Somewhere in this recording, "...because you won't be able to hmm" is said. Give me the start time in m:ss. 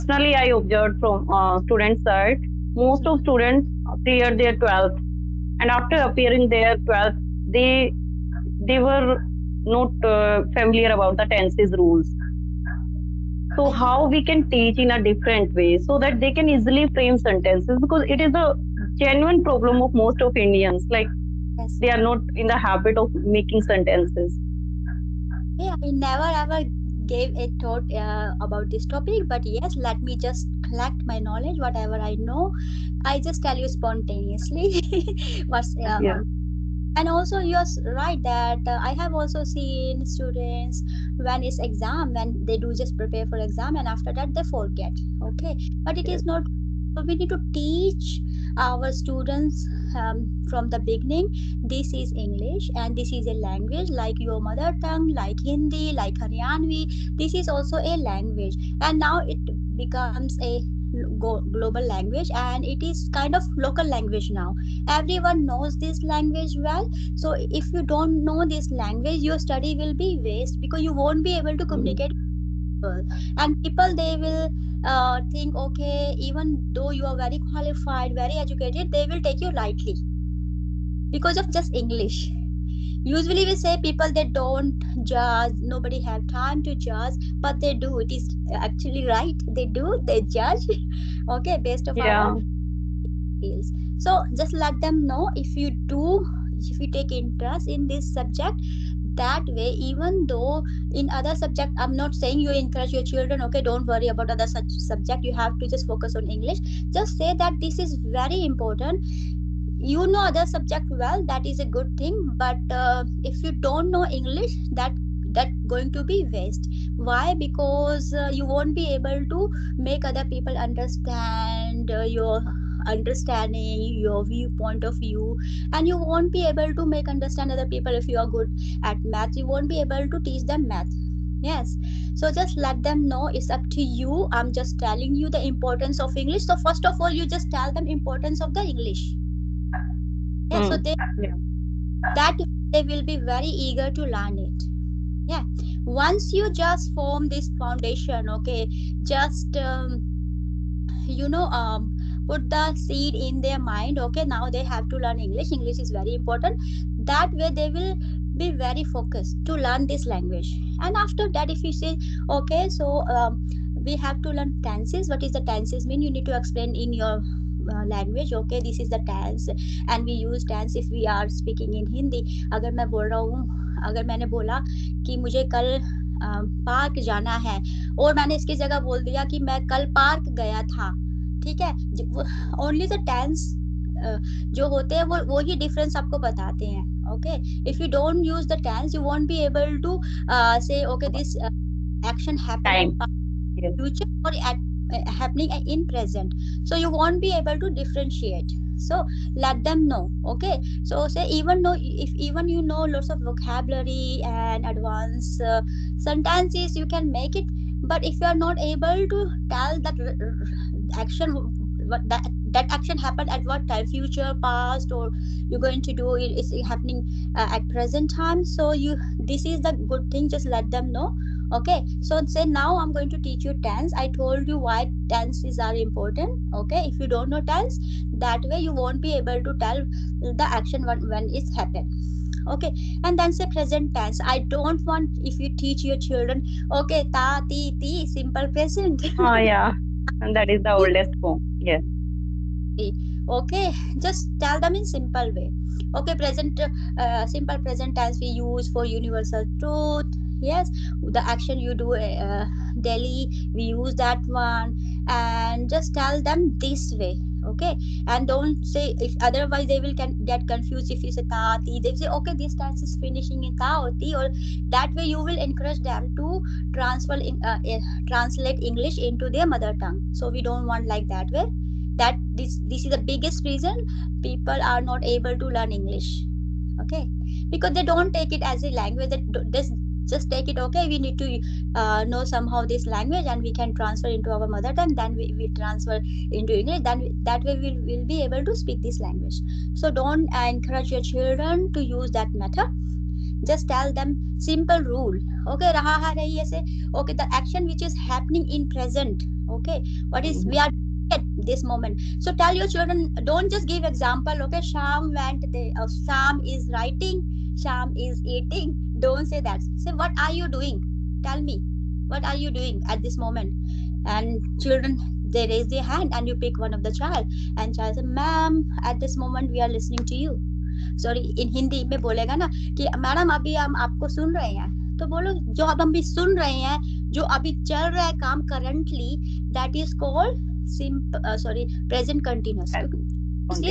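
1:10.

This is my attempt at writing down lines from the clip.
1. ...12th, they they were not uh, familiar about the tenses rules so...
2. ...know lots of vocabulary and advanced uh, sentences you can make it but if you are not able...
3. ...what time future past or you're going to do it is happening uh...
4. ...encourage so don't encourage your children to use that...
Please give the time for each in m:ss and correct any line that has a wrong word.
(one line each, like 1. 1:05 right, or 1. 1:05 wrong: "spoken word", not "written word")
1. 0:06 right
2. 3:22 right
3. 3:33 right
4. 4:49 wrong: "language", not "encourage".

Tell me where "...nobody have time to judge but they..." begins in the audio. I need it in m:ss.
1:25.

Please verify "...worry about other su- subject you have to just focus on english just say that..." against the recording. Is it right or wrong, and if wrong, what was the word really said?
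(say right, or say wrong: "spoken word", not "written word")
right.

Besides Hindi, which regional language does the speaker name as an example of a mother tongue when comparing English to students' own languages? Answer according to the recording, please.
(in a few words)
Haryanvi.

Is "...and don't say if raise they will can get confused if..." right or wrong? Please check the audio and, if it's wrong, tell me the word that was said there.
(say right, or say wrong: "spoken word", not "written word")
wrong: "otherwise", not "raise".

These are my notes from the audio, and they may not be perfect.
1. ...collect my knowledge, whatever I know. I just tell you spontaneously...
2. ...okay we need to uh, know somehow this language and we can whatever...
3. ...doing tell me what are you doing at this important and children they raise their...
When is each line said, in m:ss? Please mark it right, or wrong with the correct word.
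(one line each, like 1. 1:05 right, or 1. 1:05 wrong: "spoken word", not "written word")
1. 0:30 right
2. 4:40 wrong: "transfer", not "whatever"
3. 5:10 wrong: "moment", not "important".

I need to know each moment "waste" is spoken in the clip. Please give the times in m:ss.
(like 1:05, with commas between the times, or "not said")
1:10, 1:56.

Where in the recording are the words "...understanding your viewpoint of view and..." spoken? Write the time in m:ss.
2:02.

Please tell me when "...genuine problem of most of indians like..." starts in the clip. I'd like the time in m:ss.
0:19.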